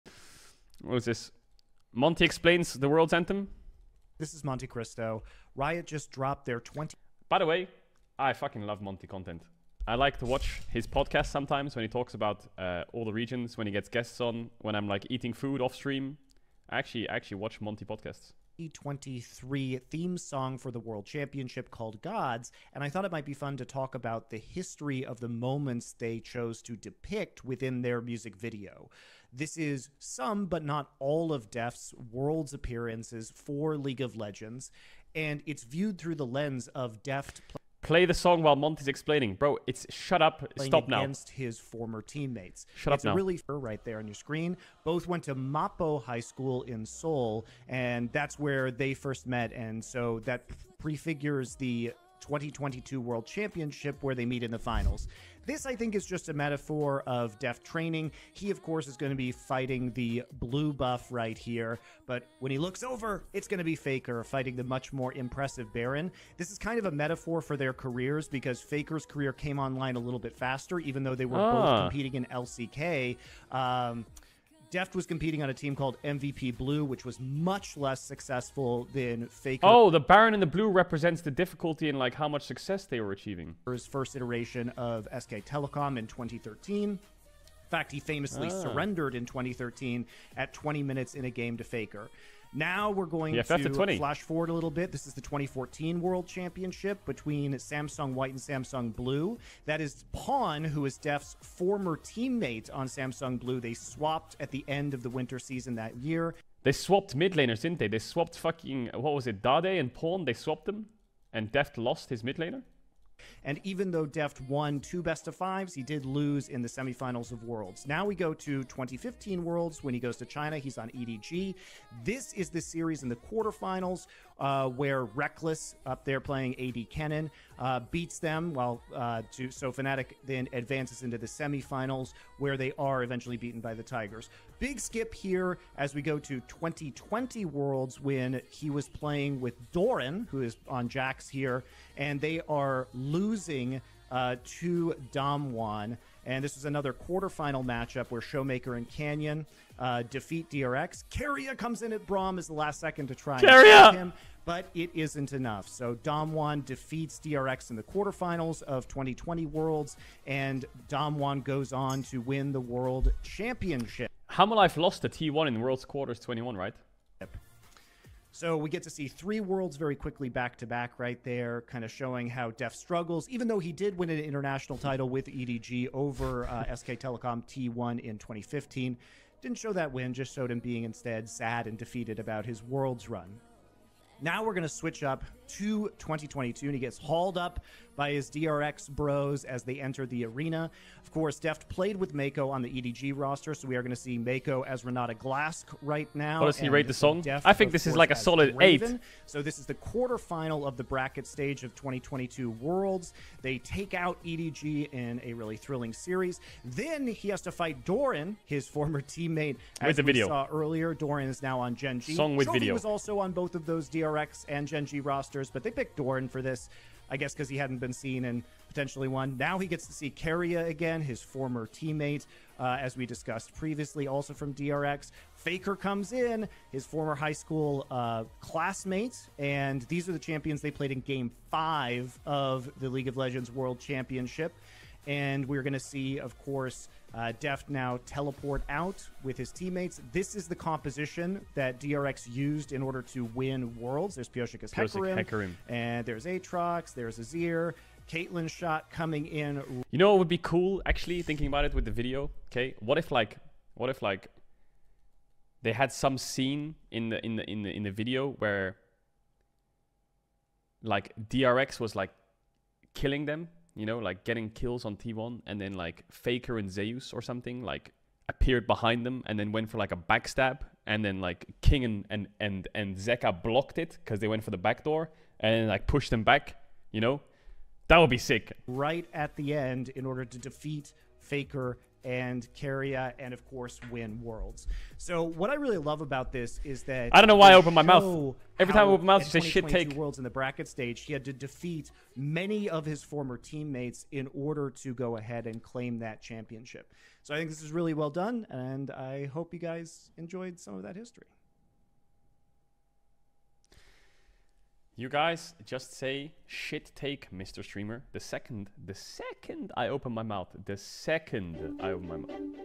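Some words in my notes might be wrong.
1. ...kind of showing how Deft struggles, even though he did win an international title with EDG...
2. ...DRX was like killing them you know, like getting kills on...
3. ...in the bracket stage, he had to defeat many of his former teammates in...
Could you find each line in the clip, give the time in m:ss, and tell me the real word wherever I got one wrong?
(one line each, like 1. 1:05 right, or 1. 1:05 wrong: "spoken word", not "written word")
1. 2:51 right
2. 4:21 right
3. 4:50 right.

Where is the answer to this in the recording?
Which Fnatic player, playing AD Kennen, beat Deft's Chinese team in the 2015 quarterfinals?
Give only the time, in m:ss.
2:05.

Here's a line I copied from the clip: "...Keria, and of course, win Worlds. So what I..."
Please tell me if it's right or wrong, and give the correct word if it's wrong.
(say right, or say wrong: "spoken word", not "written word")
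right.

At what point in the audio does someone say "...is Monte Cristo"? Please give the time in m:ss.
0:04.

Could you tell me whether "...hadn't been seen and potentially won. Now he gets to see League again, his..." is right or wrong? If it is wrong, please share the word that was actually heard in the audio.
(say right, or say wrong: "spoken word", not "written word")
wrong: "Keria", not "League".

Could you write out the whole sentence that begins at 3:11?
Of course, Deft played with Meiko on the EDG roster, so we are going to see Meiko as Renata Glasc right now.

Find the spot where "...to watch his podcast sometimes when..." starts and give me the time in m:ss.
0:10.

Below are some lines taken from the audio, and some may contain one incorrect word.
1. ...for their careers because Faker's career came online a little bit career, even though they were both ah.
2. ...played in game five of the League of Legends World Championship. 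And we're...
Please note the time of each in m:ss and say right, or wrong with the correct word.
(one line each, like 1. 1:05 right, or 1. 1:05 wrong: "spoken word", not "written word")
1. 1:07 wrong: "faster", not "career"
2. 3:50 right.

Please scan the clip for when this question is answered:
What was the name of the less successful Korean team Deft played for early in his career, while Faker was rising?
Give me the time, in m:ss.
1:16.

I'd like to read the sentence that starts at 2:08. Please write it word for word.
While uh, to, so Fnatic then advances into the semifinals where they are eventually beaten by the Tigers.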